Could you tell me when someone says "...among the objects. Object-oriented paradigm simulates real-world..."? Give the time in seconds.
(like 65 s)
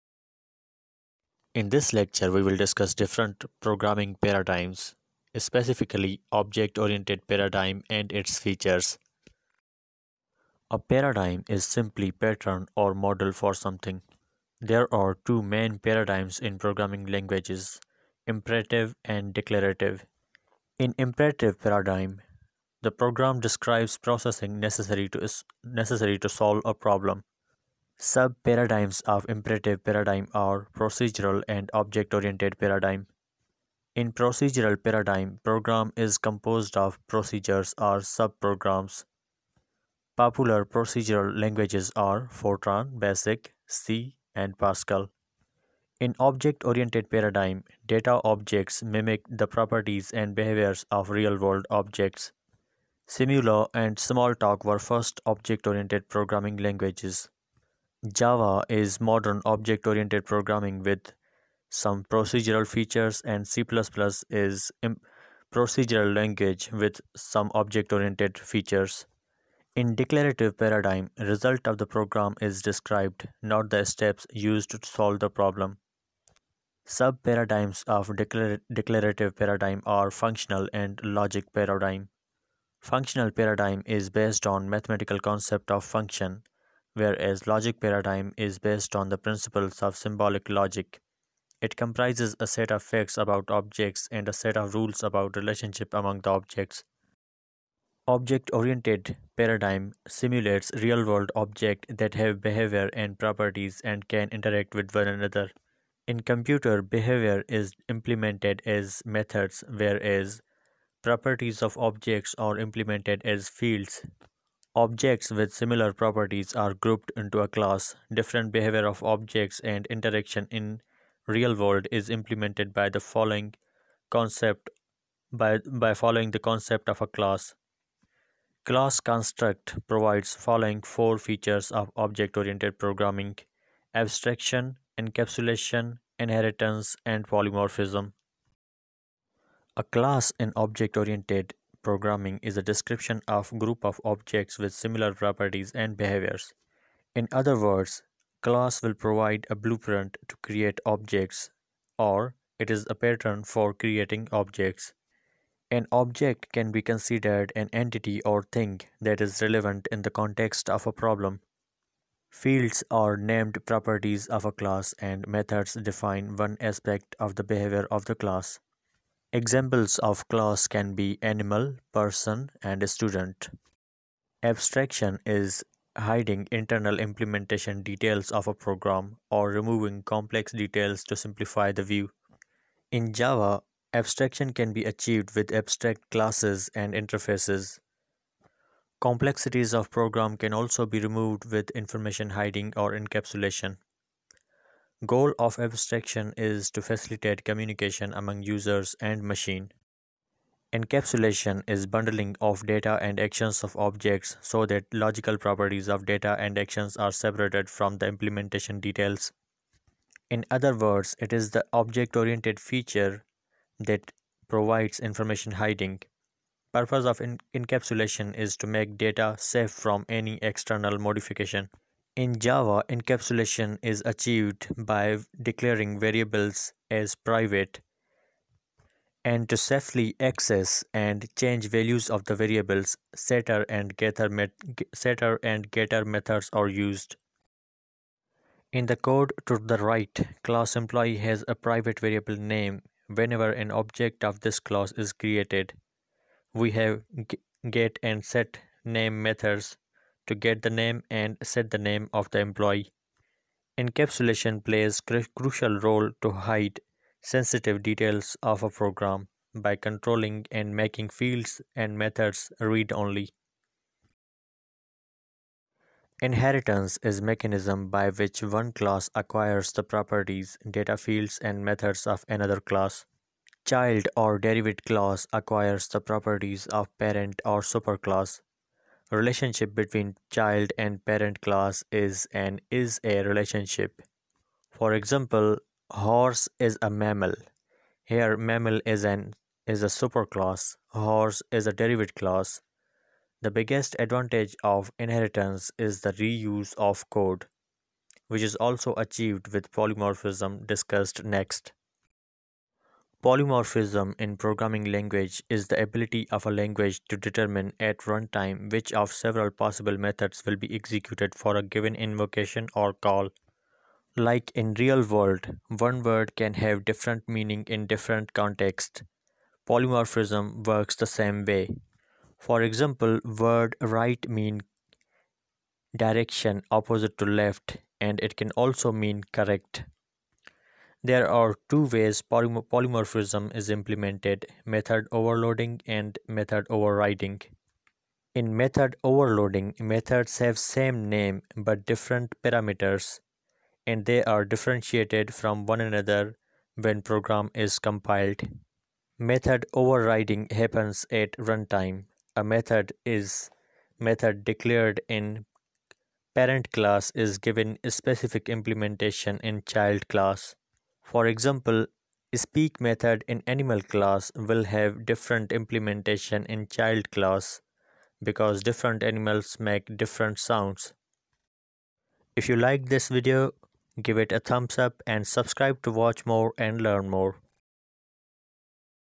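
95 s.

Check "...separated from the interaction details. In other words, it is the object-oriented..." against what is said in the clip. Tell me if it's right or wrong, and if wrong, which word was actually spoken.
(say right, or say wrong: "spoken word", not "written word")
wrong: "implementation", not "interaction".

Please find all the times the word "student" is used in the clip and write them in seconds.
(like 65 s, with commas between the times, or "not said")
172 s.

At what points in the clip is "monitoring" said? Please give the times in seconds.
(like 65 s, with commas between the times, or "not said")
not said.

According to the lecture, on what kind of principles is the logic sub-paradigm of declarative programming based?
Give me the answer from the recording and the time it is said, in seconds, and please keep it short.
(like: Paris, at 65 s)
symbolic logic, at 89 s.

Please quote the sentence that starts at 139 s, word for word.
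A class in object-oriented programming is a description of group of objects with similar properties and behaviors.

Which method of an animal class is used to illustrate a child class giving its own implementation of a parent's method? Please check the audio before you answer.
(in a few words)
speak.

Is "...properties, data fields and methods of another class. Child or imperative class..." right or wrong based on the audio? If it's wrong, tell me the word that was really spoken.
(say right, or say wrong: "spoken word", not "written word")
wrong: "derivative", not "imperative".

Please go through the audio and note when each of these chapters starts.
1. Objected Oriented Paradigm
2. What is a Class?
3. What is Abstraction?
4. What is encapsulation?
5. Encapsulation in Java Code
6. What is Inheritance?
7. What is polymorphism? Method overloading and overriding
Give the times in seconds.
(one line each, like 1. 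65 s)
1. 96 s
2. 138 s
3. 174 s
4. 200 s
5. 237 s
6. 265 s
7. 302 s.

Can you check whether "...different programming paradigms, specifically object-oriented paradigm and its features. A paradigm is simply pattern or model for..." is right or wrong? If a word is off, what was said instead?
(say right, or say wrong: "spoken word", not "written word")
right.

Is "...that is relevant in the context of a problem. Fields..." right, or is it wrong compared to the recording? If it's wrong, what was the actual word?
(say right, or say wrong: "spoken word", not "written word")
right.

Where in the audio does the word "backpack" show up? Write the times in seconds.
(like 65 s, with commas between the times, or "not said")
not said.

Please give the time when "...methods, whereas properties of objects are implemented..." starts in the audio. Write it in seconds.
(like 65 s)
109 s.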